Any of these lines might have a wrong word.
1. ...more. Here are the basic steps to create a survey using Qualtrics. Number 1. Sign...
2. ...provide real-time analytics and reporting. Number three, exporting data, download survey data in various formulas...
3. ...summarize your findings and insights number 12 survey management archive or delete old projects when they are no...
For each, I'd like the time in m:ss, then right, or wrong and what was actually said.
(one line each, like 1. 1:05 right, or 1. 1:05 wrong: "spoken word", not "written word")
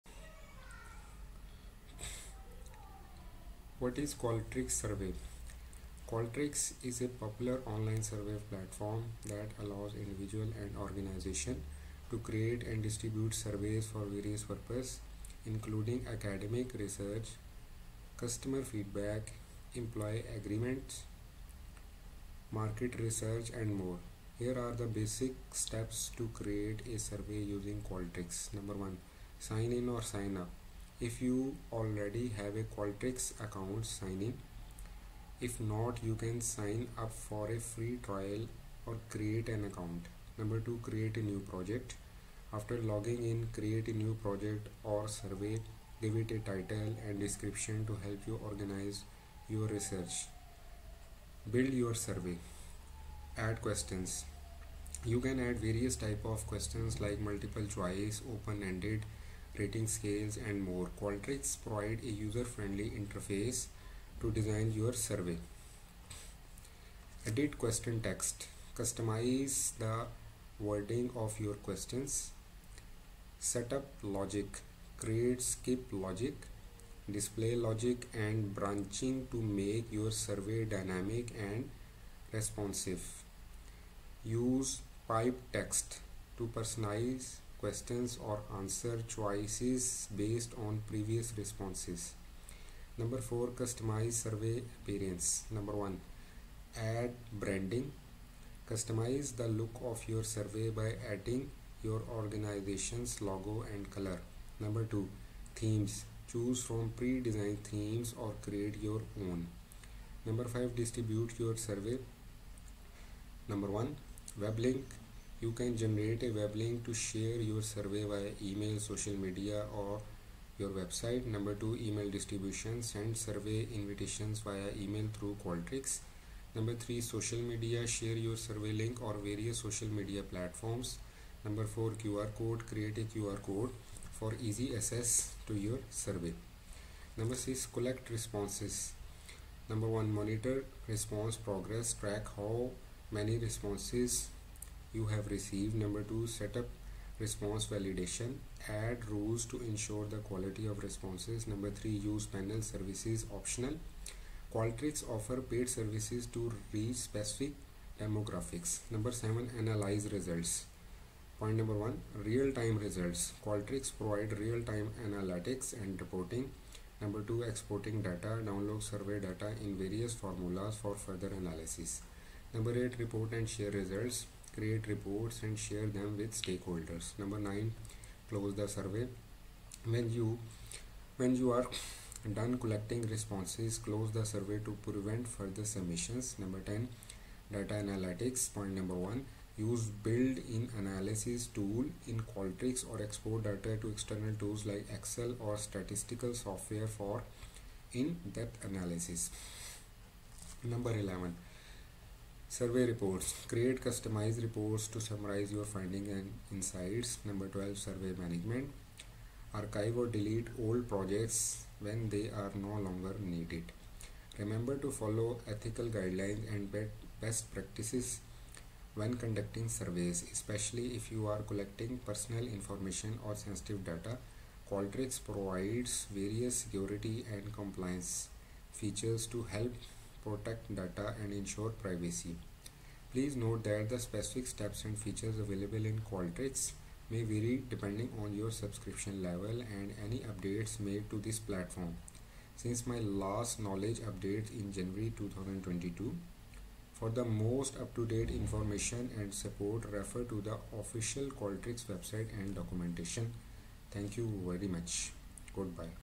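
1. 0:23 right
2. 2:43 wrong: "two", not "three"
3. 3:25 right.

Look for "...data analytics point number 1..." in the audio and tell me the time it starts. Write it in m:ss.
3:07.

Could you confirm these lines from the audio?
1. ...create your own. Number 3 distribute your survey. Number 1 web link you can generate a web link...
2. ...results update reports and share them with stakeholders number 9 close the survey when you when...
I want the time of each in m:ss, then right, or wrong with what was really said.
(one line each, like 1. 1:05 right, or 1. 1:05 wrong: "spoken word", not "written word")
1. 1:48 wrong: "5", not "3"
2. 2:53 wrong: "create", not "update".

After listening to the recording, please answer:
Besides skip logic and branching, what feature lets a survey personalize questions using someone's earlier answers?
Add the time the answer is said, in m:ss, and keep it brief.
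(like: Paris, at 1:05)
Pipe text, at 1:25.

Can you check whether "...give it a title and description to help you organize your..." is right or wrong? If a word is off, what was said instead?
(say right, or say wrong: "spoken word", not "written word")
right.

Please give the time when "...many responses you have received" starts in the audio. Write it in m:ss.
2:23.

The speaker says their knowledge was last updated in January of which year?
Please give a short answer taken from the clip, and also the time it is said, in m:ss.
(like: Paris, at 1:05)
2022, at 4:05.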